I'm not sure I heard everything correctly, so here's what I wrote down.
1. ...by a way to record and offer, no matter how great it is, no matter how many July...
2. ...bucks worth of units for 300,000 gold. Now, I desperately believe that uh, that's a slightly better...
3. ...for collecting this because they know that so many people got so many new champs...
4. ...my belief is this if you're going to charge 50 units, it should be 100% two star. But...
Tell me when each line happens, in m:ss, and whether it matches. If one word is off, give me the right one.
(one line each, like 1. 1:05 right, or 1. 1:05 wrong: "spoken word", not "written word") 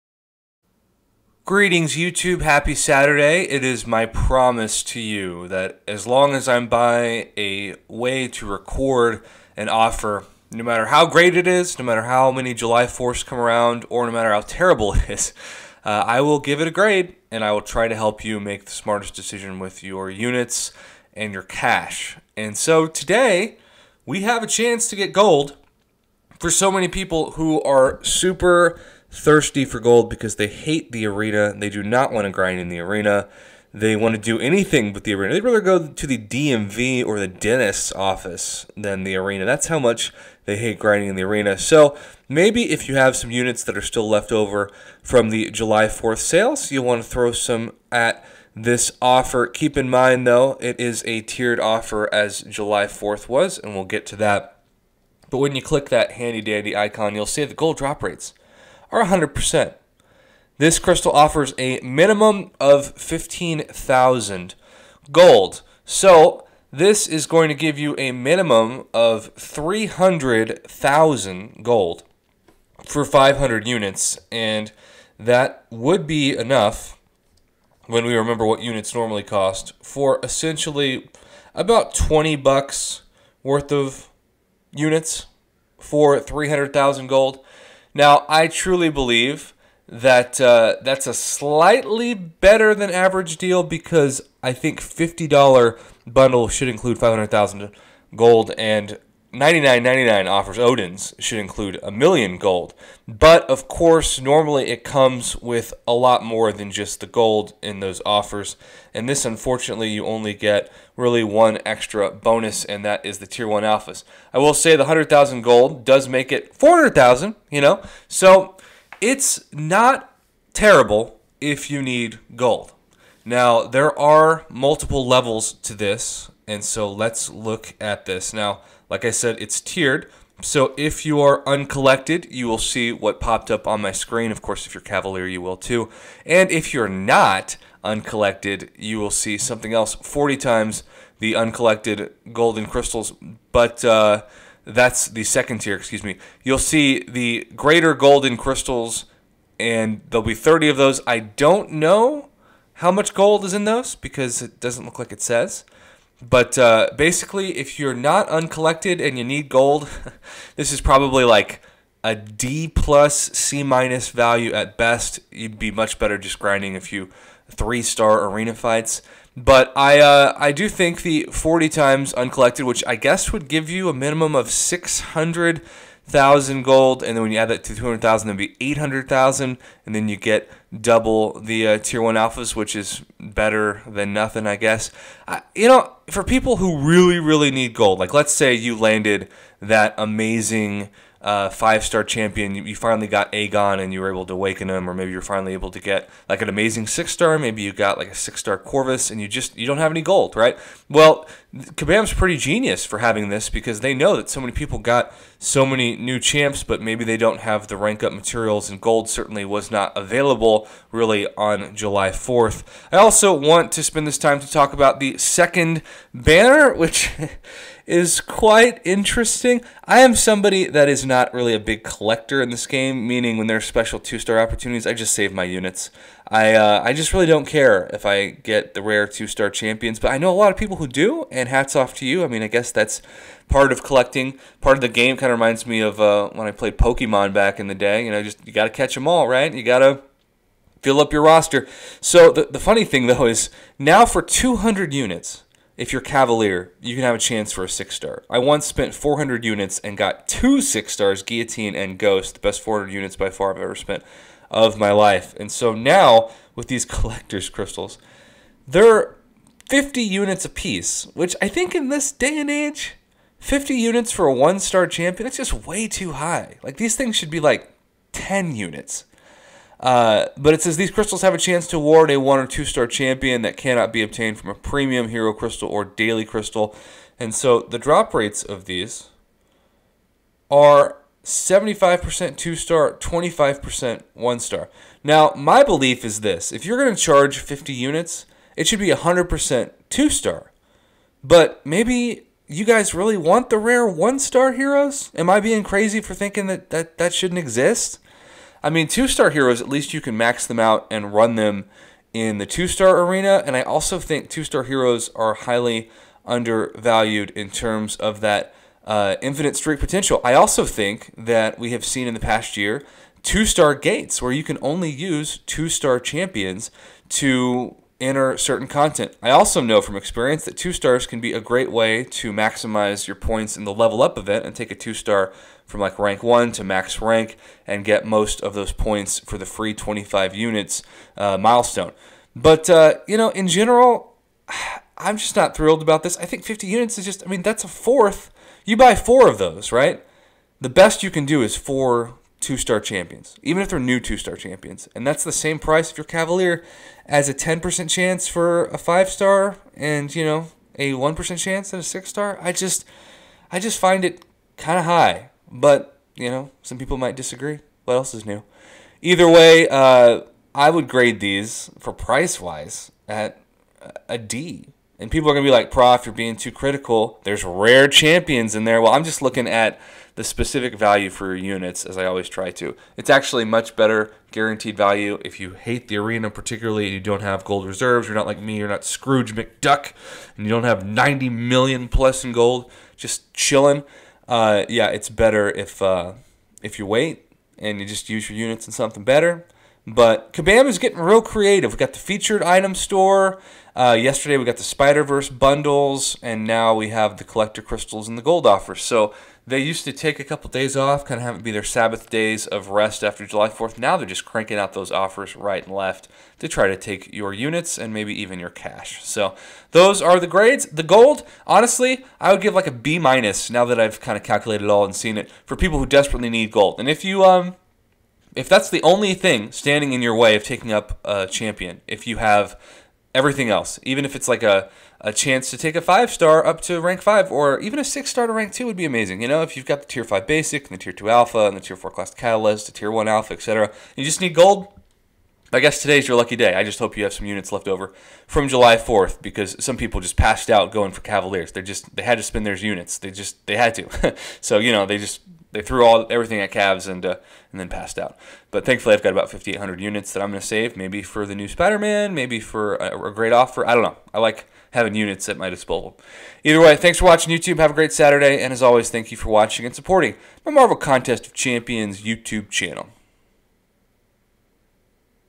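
1. 0:06 right
2. 1:22 wrong: "truly", not "desperately"
3. 3:22 wrong: "having", not "collecting"
4. 4:45 right.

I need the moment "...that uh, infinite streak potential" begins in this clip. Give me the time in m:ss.
5:08.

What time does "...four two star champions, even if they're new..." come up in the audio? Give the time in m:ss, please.
5:41.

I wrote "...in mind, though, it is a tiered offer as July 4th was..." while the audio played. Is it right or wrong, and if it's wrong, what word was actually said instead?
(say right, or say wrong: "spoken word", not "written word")
right.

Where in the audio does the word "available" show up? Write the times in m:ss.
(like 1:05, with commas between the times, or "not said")
3:29.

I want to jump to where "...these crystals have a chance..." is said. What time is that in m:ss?
4:30.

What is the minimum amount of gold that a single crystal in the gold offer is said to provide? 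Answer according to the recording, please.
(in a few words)
15,000 gold.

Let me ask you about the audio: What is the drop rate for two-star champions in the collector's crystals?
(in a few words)
75%.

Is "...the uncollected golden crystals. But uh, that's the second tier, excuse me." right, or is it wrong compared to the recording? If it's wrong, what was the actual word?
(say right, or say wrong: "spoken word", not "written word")
right.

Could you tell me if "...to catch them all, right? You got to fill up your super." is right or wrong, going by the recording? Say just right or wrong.
wrong.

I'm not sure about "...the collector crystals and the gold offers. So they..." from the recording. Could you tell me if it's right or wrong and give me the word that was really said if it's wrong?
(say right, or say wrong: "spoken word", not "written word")
right.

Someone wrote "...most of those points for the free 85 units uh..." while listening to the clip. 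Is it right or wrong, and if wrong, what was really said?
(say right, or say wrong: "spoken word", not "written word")
wrong: "25", not "85".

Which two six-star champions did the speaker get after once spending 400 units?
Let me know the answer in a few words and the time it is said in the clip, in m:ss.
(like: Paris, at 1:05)
Guillotine and Ghost, at 4:11.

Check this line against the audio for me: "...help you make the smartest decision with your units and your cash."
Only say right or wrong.
right.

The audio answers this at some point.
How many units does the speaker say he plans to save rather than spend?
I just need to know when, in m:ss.
7:29.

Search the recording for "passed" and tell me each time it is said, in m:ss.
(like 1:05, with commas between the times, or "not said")
7:20, 7:27.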